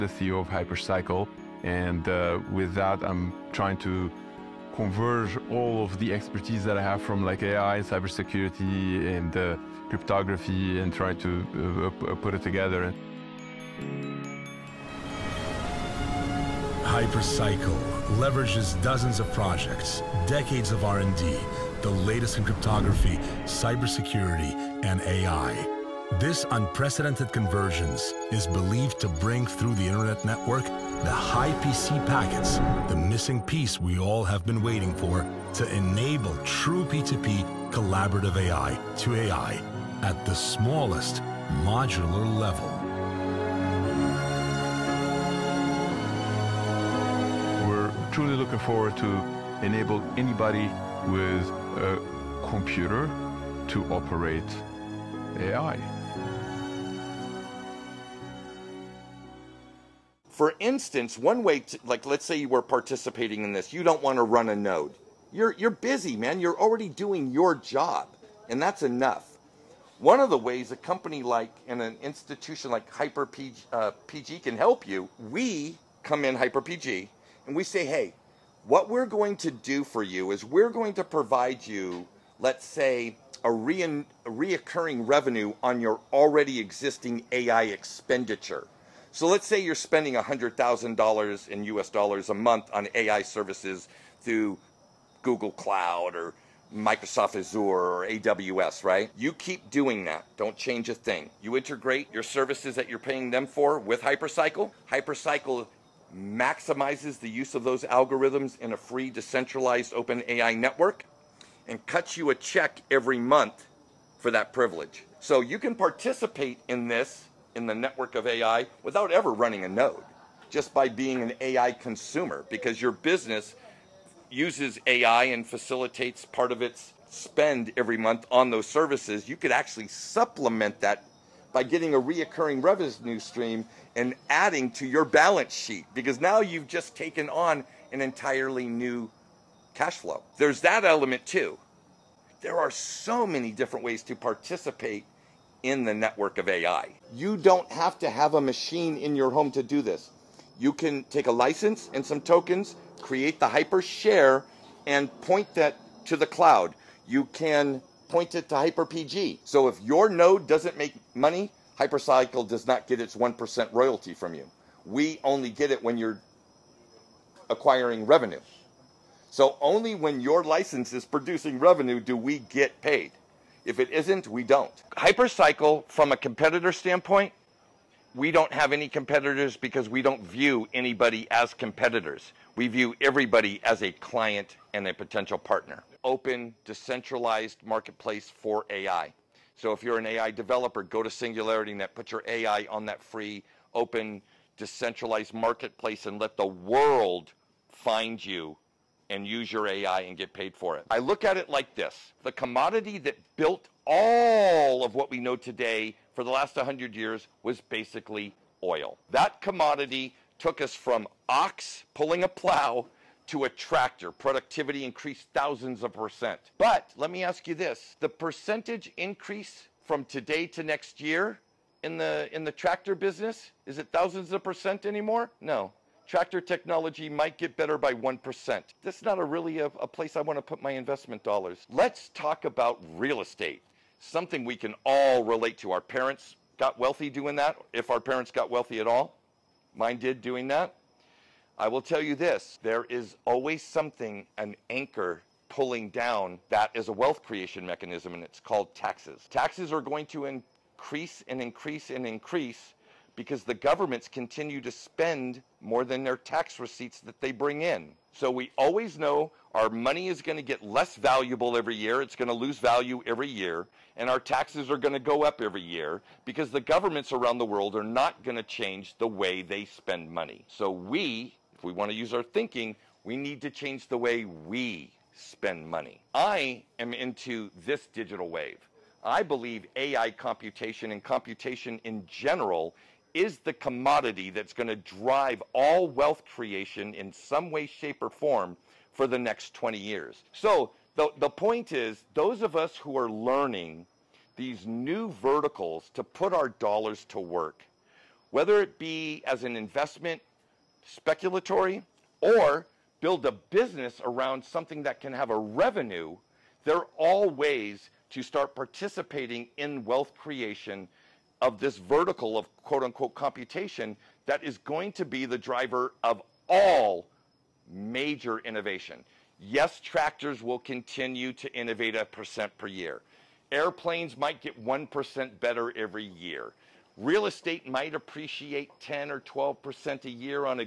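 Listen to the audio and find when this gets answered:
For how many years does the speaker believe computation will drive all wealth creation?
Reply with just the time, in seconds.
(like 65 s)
289 s.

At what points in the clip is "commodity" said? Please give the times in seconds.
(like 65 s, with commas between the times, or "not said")
202 s, 209 s, 283 s.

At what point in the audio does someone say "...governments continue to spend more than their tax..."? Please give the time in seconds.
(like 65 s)
253 s.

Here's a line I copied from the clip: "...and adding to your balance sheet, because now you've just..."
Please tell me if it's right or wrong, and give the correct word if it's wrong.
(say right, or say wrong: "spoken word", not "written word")
right.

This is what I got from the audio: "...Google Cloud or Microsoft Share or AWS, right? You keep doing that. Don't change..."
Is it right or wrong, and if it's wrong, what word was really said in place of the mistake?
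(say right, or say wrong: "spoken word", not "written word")
wrong: "Azure", not "Share".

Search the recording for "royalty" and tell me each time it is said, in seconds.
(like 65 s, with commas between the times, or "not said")
163 s.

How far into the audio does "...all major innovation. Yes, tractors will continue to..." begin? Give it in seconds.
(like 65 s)
316 s.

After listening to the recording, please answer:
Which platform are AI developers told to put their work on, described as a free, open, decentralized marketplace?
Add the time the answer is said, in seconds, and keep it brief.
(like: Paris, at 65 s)
SingularityNet, at 191 s.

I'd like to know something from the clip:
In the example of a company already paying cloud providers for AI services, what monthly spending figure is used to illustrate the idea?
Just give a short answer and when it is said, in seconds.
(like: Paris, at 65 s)
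$100,000, at 90 s.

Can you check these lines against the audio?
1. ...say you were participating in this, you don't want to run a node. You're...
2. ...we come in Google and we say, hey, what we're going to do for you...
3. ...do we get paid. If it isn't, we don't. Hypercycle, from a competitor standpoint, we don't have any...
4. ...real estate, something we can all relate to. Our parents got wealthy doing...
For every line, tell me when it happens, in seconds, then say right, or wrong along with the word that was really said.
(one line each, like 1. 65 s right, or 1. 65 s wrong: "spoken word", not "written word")
1. 62 s right
2. 75 s wrong: "HyperPG", not "Google"
3. 172 s right
4. 232 s right.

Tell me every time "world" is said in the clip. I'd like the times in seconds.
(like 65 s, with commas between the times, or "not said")
196 s, 267 s.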